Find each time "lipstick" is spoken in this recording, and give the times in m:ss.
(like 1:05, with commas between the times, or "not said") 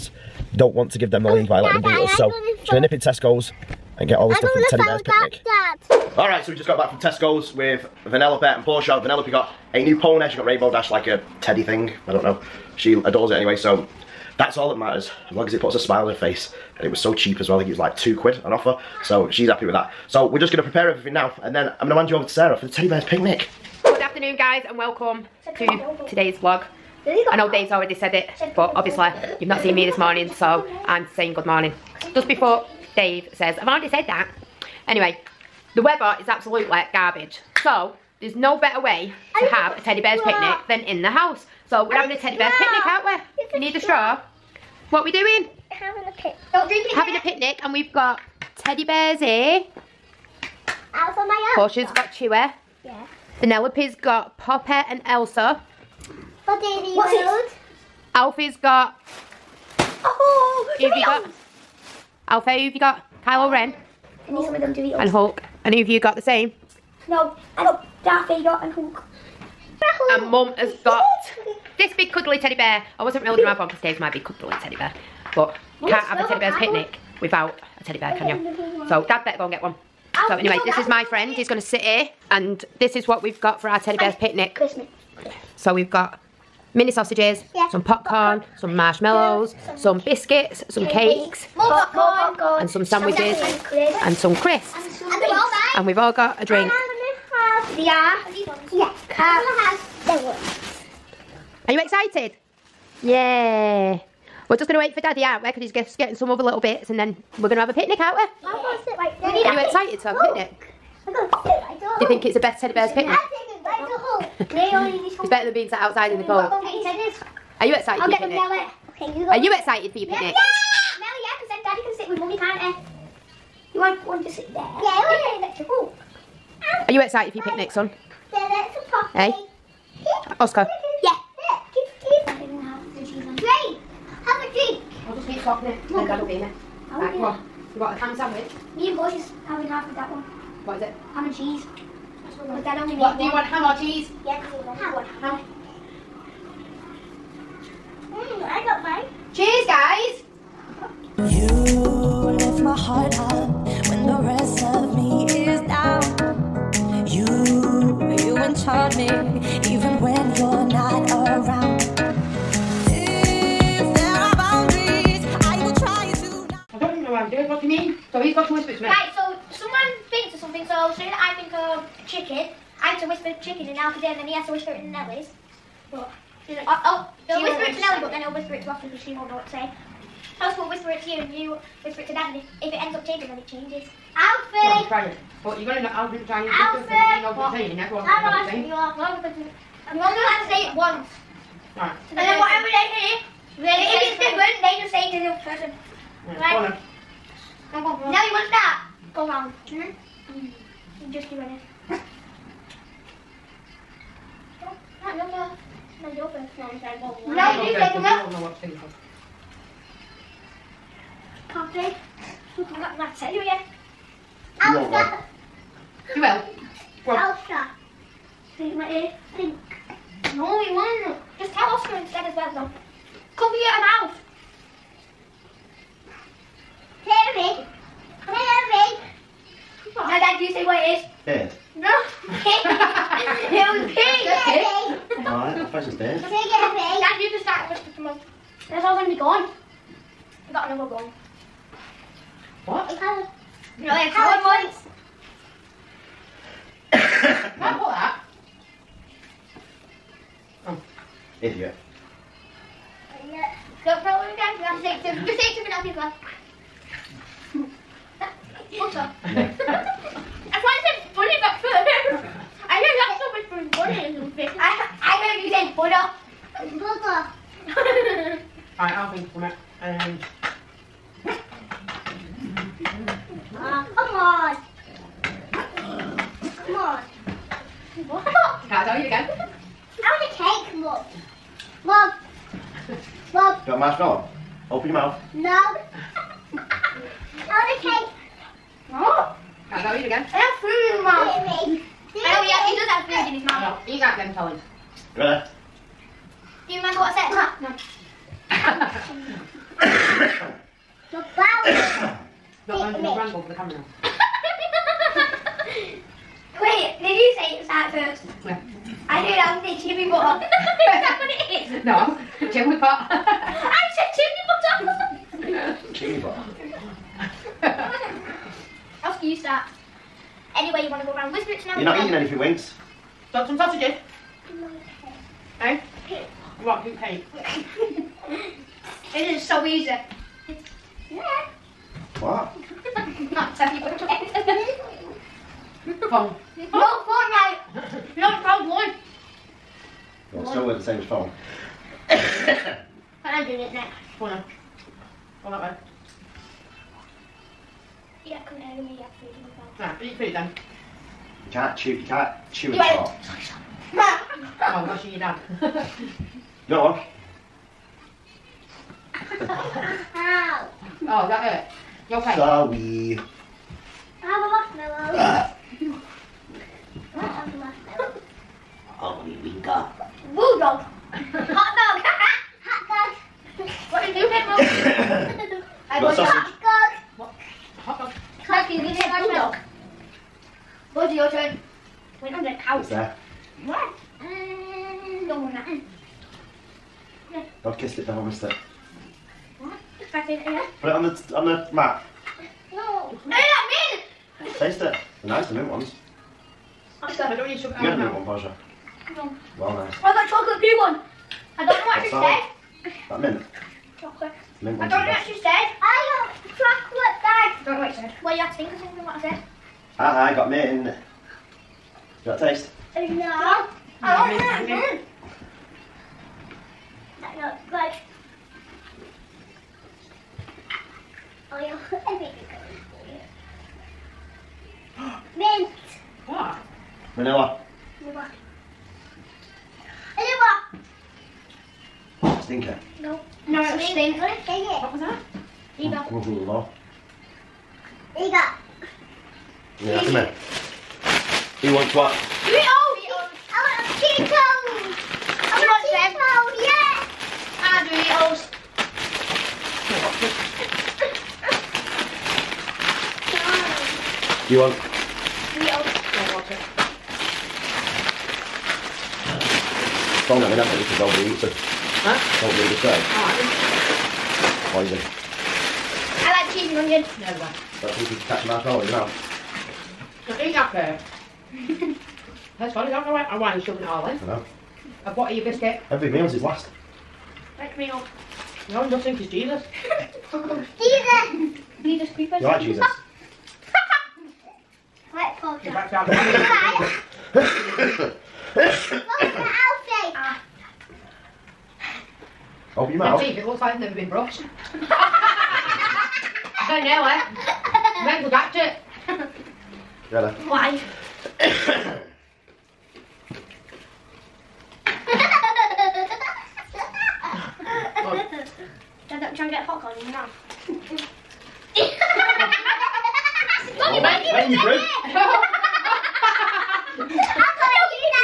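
not said.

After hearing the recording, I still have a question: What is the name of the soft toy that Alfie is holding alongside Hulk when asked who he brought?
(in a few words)
Kylo Ren.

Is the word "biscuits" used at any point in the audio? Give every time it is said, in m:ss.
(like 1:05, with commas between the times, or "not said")
1:30, 7:55.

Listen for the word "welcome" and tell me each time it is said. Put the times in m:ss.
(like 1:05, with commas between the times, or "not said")
0:24.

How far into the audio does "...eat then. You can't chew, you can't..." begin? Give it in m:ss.
5:50.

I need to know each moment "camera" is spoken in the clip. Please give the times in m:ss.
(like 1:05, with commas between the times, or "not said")
5:03.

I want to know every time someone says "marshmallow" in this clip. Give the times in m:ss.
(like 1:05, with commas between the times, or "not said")
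1:28, 4:43, 6:05, 7:48.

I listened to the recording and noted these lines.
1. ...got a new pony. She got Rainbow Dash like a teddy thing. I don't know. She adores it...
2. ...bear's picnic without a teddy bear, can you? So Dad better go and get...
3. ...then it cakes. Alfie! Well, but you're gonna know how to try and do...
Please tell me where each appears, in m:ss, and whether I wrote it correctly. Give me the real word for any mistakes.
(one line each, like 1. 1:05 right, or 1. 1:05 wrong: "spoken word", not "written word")
1. 0:09 right
2. 1:16 right
3. 3:03 wrong: "changes", not "cakes".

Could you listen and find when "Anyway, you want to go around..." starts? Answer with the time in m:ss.
5:20.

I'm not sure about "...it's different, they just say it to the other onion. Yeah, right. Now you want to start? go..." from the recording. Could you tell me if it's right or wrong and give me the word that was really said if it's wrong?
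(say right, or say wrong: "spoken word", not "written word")
wrong: "person", not "onion".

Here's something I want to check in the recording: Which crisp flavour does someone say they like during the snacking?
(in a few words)
cheese and onion.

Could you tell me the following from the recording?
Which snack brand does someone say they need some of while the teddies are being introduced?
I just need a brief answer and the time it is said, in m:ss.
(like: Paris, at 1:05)
Doritos, at 1:04.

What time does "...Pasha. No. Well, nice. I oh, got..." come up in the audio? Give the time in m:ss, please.
6:38.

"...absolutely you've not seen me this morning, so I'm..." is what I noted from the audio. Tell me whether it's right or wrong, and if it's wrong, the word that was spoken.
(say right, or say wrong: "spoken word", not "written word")
wrong: "obviously", not "absolutely".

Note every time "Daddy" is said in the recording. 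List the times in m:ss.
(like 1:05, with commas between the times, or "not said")
1:45, 2:01.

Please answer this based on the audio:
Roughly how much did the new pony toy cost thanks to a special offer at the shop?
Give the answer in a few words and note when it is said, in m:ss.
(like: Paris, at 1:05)
two quid, at 0:17.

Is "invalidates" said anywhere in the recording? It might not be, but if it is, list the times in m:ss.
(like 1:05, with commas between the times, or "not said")
not said.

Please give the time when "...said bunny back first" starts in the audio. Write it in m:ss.
4:20.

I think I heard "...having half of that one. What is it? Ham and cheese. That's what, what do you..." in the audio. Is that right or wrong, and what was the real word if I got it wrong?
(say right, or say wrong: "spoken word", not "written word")
right.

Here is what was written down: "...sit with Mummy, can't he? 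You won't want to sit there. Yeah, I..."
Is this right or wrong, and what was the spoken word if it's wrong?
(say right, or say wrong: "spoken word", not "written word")
right.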